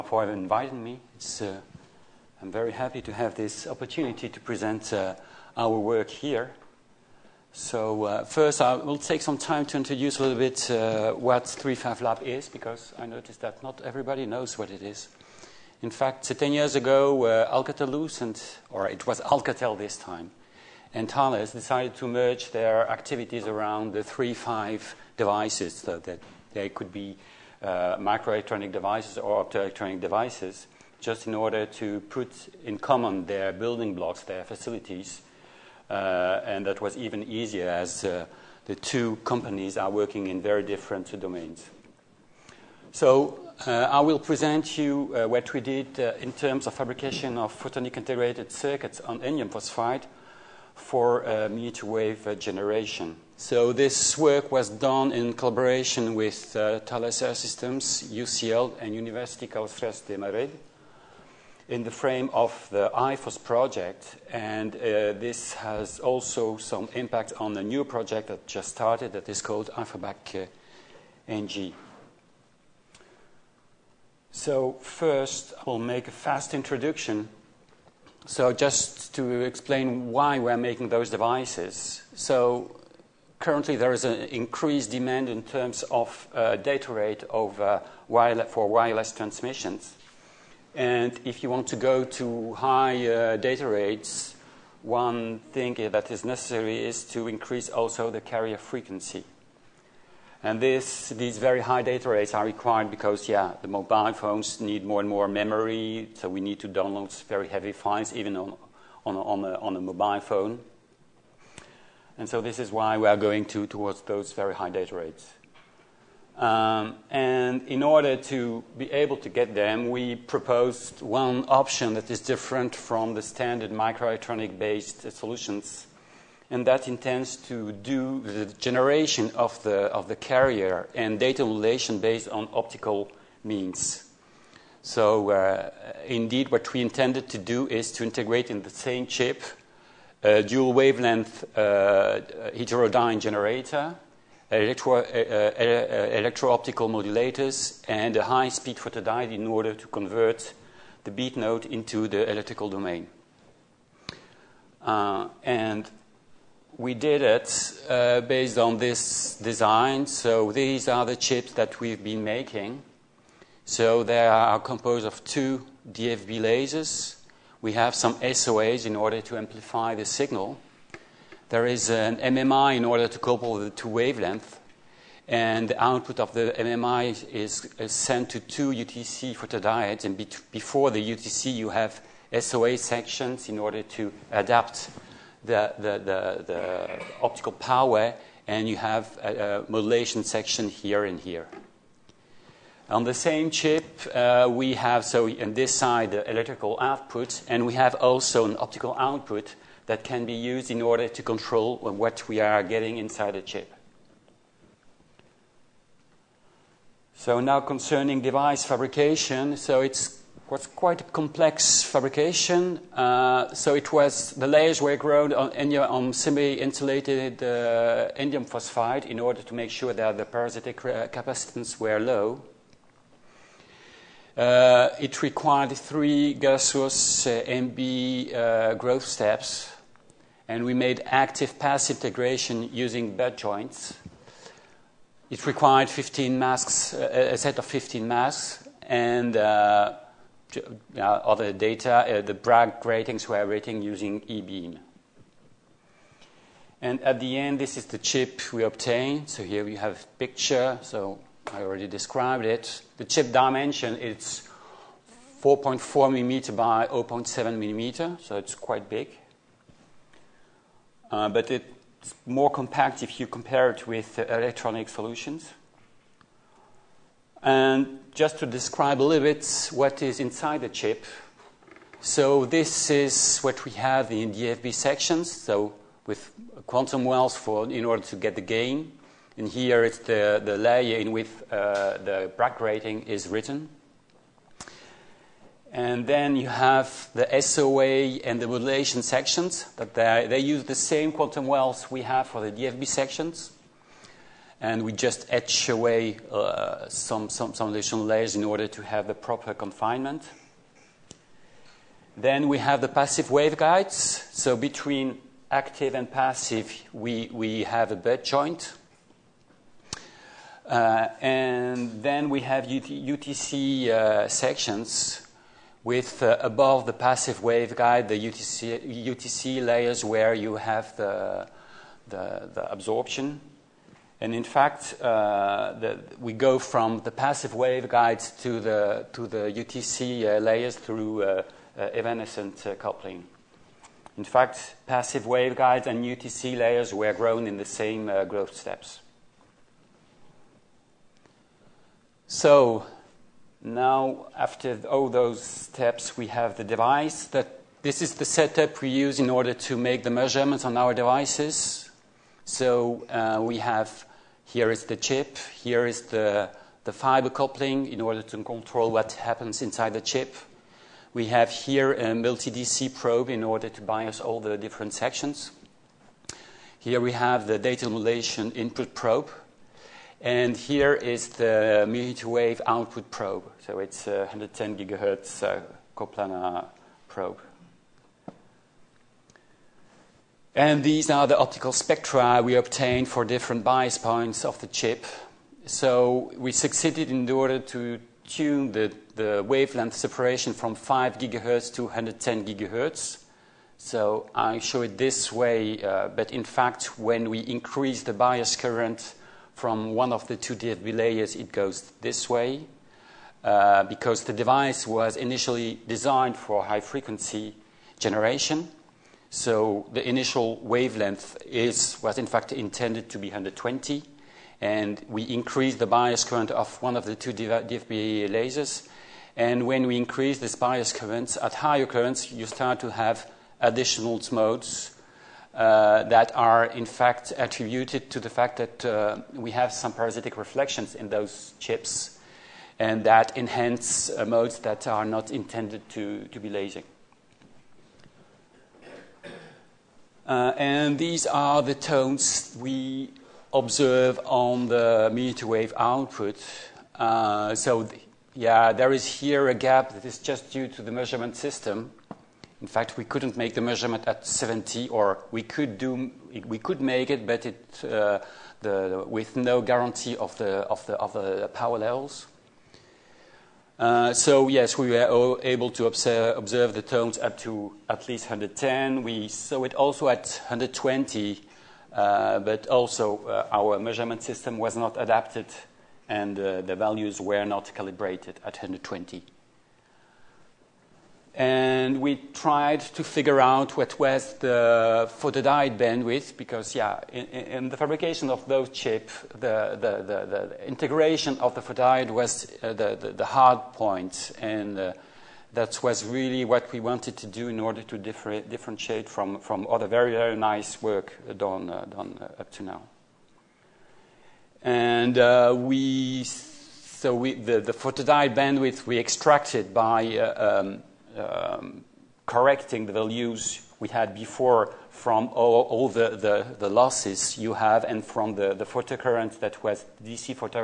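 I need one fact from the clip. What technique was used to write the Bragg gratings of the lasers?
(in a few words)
E-beam.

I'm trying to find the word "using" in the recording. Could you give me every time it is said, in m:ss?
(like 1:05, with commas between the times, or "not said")
3:52, 4:03.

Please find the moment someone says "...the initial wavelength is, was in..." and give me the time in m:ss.
6:49.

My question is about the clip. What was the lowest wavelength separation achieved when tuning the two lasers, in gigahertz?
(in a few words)
5 gigahertz.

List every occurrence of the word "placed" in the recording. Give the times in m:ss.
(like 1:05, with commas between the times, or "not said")
not said.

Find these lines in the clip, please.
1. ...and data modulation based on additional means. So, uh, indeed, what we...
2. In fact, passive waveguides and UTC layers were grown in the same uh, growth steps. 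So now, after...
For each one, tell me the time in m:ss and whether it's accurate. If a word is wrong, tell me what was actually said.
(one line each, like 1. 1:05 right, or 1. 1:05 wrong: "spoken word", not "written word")
1. 2:10 wrong: "optical", not "additional"
2. 5:34 right.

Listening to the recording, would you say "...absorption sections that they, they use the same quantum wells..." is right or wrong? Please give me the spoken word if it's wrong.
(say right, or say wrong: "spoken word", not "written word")
wrong: "modulation", not "absorption".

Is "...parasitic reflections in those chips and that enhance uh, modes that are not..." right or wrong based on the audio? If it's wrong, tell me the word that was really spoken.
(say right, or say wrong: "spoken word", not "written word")
right.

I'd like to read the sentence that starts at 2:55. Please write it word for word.
And the output of the MMI is, sent to two UTC photodiodes.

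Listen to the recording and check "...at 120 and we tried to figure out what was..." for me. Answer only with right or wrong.
right.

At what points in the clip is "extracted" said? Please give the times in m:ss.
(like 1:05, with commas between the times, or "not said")
8:28.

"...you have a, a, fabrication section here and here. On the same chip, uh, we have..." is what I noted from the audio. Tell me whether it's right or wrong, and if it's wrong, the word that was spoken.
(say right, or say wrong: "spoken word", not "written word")
wrong: "modulation", not "fabrication".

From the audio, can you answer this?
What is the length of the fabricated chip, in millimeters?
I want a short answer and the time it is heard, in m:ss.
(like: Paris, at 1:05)
4.4 millimeter, at 4:15.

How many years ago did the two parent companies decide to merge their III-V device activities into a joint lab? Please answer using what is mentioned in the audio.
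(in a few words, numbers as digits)
10.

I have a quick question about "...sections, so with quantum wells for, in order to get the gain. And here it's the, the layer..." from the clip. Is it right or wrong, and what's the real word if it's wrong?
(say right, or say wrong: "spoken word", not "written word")
right.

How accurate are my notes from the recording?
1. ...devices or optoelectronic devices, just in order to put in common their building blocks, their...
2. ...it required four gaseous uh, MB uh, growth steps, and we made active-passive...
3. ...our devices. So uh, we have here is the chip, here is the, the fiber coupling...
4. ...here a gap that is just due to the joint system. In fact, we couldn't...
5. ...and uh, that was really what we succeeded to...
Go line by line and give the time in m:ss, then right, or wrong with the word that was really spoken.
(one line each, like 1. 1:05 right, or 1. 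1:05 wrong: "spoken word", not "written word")
1. 0:28 right
2. 3:44 wrong: "three", not "four"
3. 5:50 right
4. 7:29 wrong: "measurement", not "joint"
5. 8:14 wrong: "wanted", not "succeeded".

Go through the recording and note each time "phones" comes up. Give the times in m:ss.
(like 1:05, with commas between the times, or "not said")
1:44, 1:50.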